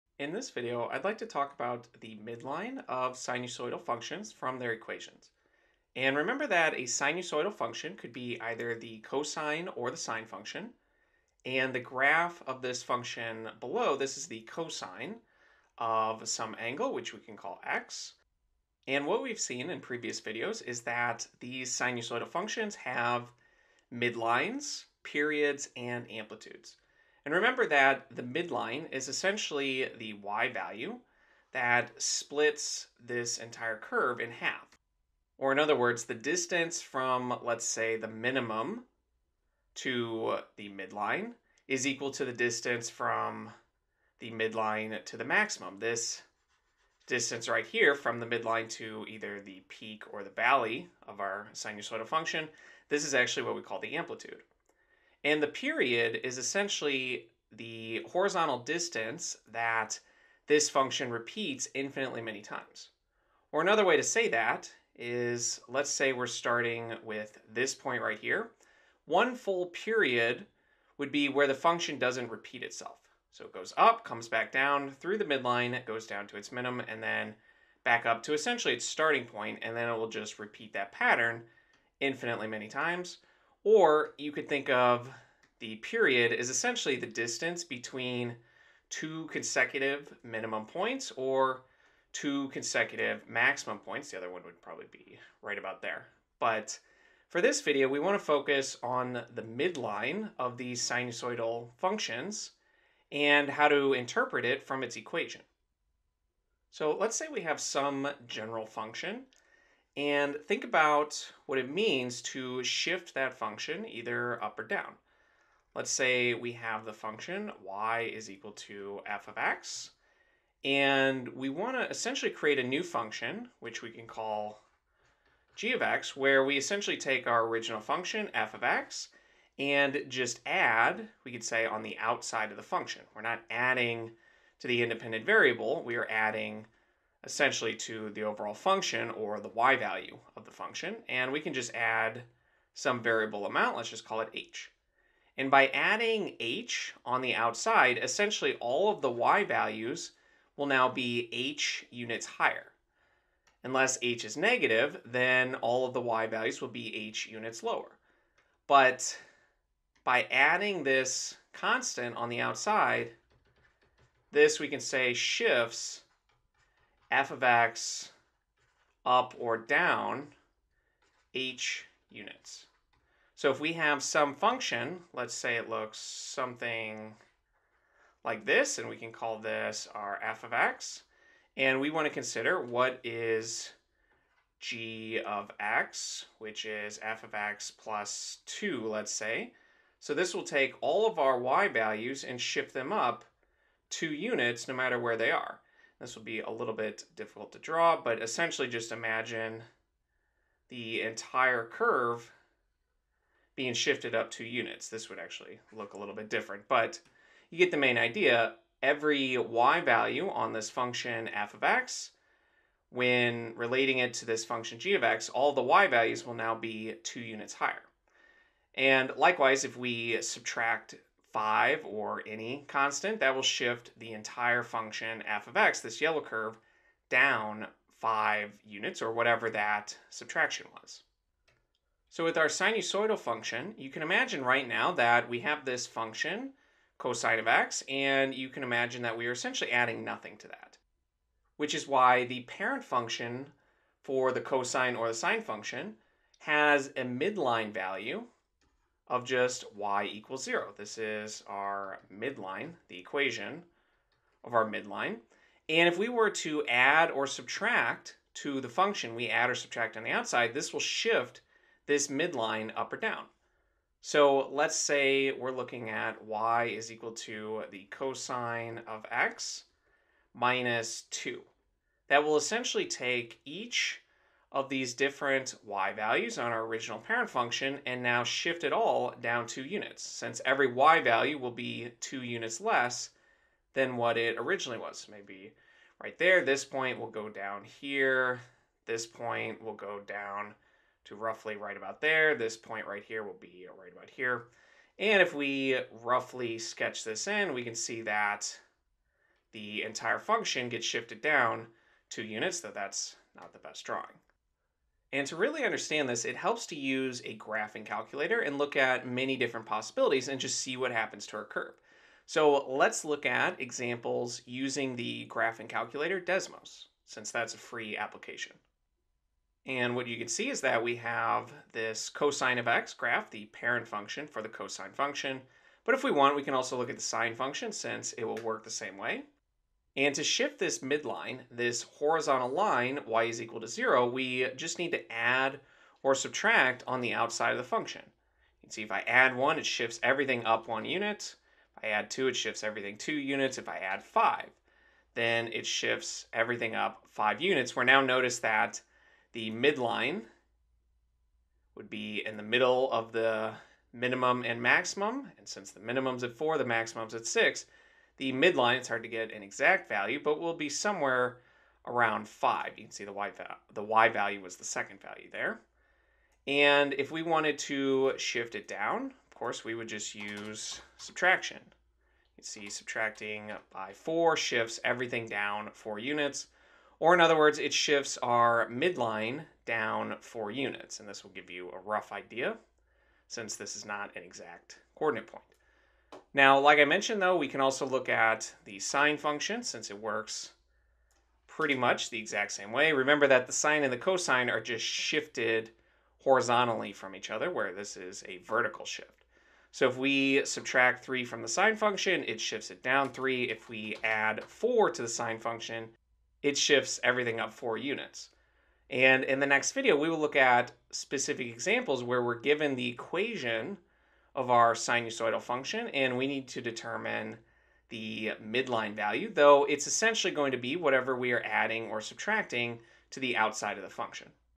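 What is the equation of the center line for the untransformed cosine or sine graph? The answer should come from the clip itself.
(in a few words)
y equals 0.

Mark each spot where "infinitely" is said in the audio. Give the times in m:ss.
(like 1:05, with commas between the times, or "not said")
1:01, 1:21.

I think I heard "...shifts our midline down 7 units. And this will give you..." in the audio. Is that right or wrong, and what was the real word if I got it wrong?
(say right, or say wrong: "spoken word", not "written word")
wrong: "4", not "7".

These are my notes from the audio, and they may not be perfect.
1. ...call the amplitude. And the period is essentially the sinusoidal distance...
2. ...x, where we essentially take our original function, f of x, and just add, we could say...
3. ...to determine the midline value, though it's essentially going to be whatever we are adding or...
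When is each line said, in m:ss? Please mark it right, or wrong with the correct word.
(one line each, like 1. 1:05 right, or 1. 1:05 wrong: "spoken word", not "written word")
1. 0:53 wrong: "horizontal", not "sinusoidal"
2. 2:05 right
3. 6:56 right.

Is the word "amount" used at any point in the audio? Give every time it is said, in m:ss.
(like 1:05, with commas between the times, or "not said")
2:23.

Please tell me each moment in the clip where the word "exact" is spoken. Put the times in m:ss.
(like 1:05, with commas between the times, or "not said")
5:59, 6:24, 6:32.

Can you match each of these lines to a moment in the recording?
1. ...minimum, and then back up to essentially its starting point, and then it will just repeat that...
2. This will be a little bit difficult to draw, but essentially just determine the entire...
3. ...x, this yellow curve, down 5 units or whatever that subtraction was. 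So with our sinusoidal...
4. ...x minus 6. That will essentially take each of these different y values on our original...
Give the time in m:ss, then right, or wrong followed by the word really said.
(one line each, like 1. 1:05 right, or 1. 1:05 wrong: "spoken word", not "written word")
1. 1:16 right
2. 3:16 wrong: "imagine", not "determine"
3. 3:45 right
4. 4:29 wrong: "2", not "6".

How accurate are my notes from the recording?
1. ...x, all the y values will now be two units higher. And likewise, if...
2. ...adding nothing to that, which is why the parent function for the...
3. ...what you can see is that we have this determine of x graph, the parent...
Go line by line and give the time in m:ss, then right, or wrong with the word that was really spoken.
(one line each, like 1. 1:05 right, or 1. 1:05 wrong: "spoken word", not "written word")
1. 3:35 right
2. 3:59 right
3. 5:19 wrong: "cosine", not "determine".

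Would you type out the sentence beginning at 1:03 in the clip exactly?
Or another way to say that is, let's say we're starting with this point right here.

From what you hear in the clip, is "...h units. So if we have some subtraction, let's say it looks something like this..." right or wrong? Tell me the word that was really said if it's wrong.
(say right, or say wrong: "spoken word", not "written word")
wrong: "function", not "subtraction".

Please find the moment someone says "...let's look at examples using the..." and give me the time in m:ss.
5:12.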